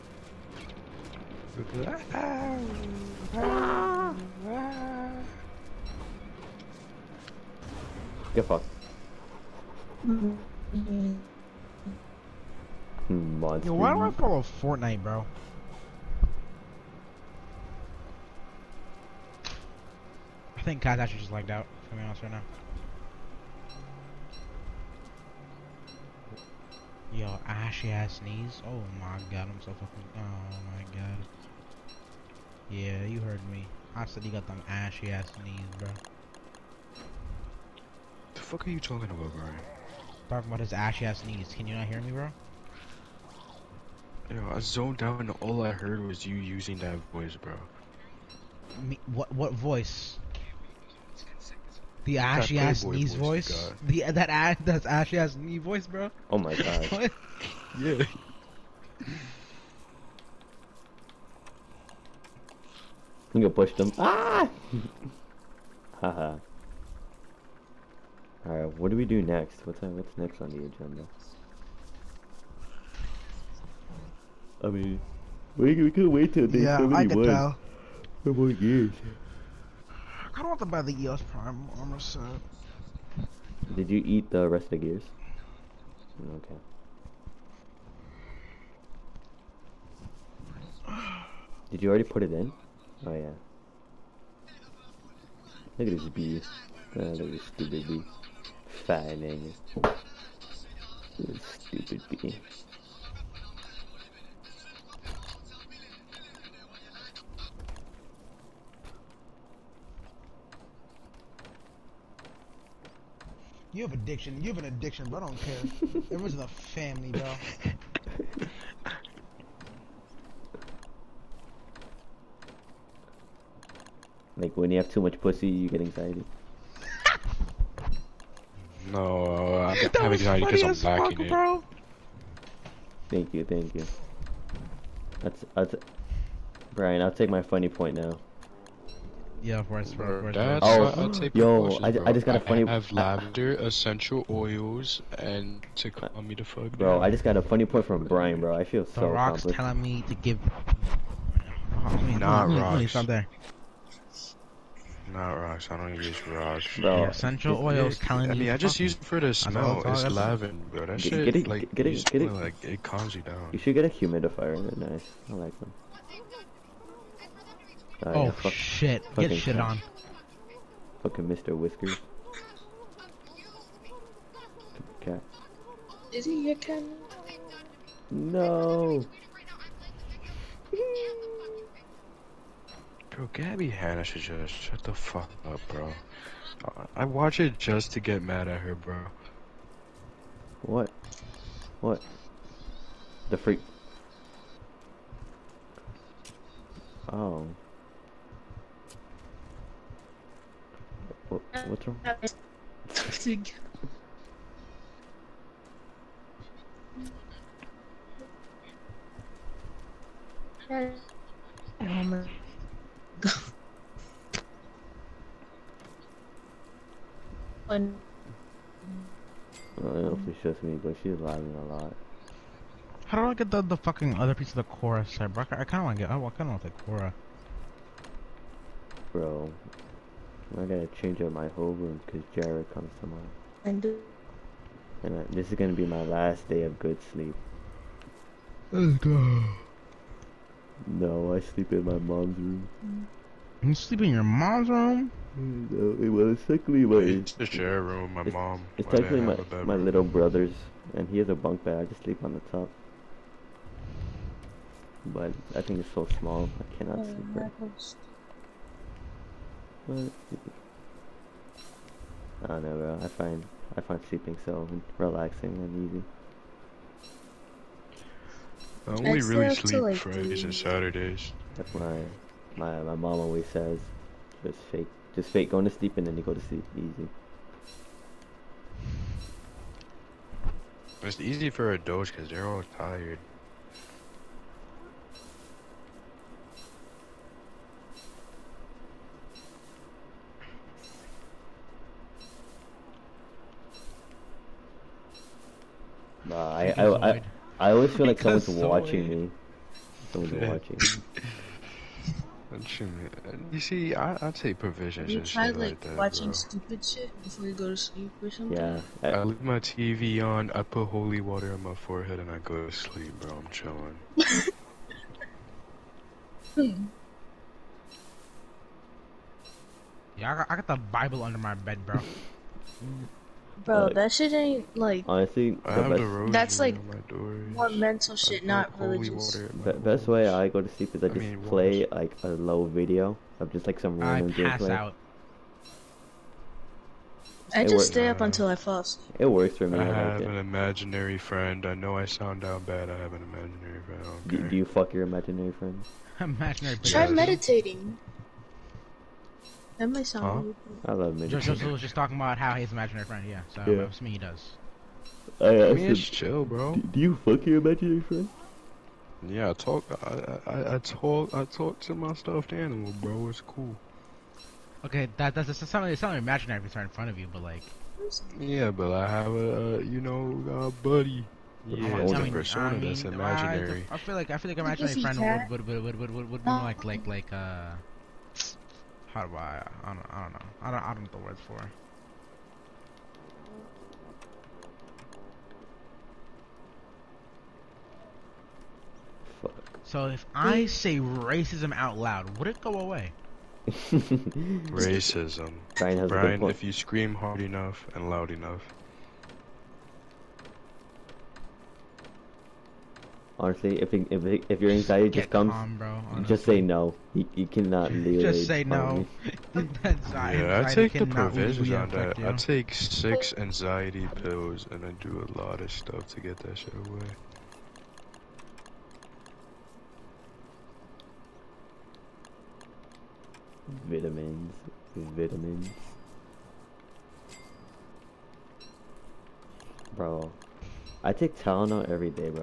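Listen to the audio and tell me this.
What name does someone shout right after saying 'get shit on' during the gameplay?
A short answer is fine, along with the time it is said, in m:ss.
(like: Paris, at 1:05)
Mr. Whiskers, at 2:51.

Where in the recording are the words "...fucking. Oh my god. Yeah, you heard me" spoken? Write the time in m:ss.
0:29.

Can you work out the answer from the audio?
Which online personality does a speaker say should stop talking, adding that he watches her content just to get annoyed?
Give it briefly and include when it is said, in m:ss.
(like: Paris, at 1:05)
Gabbie Hanna, at 3:03.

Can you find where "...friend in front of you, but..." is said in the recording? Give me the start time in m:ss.
6:06.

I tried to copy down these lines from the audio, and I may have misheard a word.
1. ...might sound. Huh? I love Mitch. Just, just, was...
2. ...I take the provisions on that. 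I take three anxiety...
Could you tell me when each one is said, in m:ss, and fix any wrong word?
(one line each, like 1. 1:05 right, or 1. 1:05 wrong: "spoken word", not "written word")
1. 5:49 right
2. 6:50 wrong: "six", not "three".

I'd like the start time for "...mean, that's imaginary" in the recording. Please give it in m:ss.
6:12.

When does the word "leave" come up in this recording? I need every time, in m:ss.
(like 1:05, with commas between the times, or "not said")
5:09, 6:47.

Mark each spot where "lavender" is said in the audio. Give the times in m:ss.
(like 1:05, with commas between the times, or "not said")
2:22, 2:40.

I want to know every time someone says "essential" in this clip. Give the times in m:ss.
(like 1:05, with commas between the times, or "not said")
2:23, 2:37.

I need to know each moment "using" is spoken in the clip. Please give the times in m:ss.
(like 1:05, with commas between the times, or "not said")
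0:46.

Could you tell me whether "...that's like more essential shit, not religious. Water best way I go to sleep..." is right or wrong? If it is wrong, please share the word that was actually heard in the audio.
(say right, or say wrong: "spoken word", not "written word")
wrong: "mental", not "essential".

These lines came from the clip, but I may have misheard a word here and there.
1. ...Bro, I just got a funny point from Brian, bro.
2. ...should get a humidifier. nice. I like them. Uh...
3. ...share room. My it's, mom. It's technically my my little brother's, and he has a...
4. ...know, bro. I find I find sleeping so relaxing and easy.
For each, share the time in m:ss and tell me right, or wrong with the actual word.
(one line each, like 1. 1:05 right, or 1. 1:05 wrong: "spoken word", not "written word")
1. 2:26 right
2. 2:43 right
3. 4:07 right
4. 4:22 right.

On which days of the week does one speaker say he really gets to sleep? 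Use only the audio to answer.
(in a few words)
Fridays and Saturdays.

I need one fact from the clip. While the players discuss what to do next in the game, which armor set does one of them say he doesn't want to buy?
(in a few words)
EOS Prime armor set.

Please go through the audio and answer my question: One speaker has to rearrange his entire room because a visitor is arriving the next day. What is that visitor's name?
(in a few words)
Jared.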